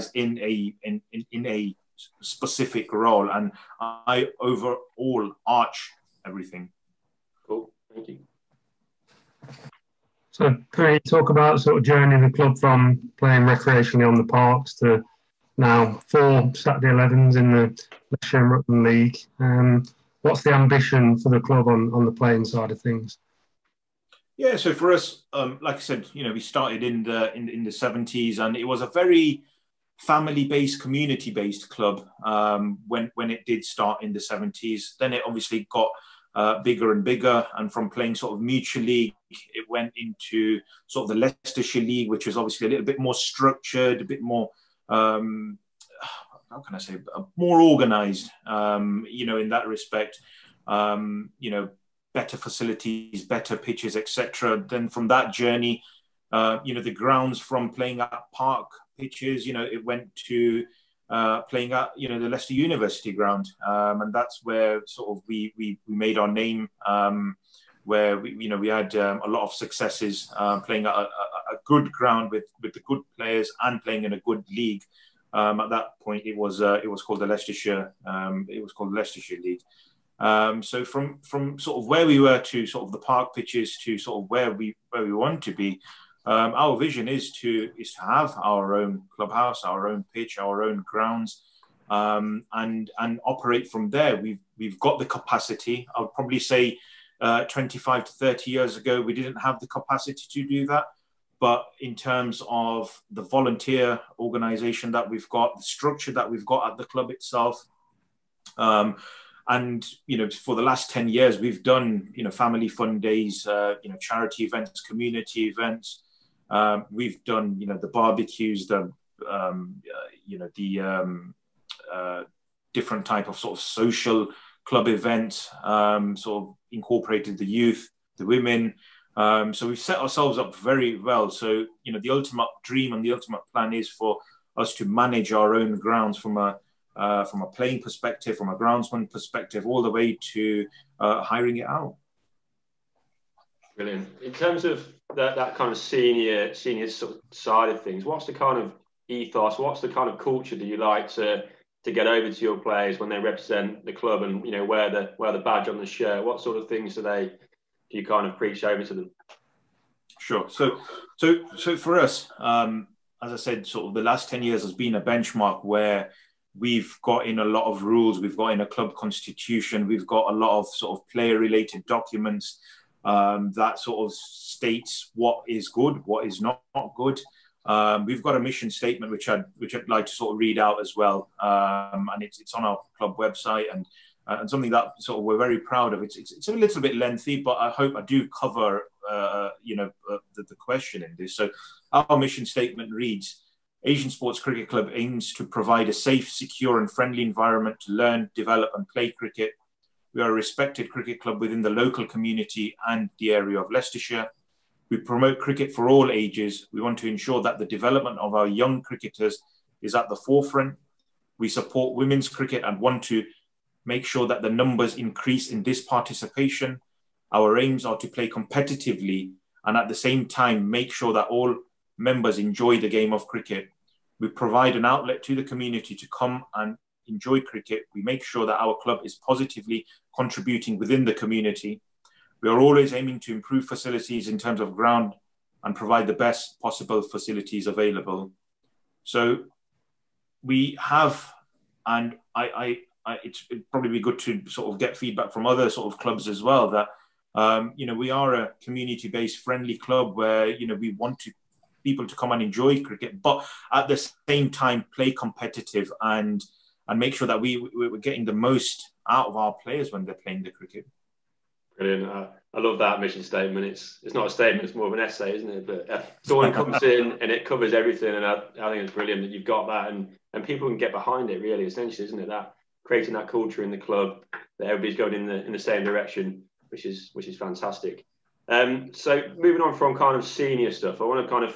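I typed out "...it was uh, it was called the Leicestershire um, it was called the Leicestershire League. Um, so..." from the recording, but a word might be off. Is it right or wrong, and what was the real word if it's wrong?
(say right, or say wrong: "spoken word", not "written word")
right.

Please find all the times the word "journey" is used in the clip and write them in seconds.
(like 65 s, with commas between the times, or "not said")
11 s, 55 s.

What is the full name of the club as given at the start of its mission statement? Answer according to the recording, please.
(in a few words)
Asian Sports Cricket Club.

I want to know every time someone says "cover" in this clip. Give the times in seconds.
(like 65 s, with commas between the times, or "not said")
188 s, 267 s.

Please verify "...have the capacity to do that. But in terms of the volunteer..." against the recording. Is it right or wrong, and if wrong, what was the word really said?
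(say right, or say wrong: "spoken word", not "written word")
right.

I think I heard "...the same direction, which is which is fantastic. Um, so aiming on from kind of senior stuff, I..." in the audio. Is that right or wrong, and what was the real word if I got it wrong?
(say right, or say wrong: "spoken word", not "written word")
wrong: "moving", not "aiming".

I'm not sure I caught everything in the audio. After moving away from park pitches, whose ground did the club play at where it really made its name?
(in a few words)
Leicester University.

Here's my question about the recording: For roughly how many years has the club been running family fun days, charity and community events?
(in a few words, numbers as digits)
10.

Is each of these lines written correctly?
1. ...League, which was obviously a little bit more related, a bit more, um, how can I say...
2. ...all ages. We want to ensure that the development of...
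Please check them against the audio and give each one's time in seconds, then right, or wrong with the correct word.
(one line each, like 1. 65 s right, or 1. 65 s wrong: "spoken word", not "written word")
1. 41 s wrong: "structured", not "related"
2. 205 s right.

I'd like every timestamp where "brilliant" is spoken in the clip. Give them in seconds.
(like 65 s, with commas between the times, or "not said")
143 s, 261 s, 268 s.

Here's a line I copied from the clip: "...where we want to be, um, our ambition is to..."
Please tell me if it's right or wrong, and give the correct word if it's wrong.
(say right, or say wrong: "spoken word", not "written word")
wrong: "vision", not "ambition".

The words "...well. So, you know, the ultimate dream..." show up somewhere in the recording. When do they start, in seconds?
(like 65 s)
130 s.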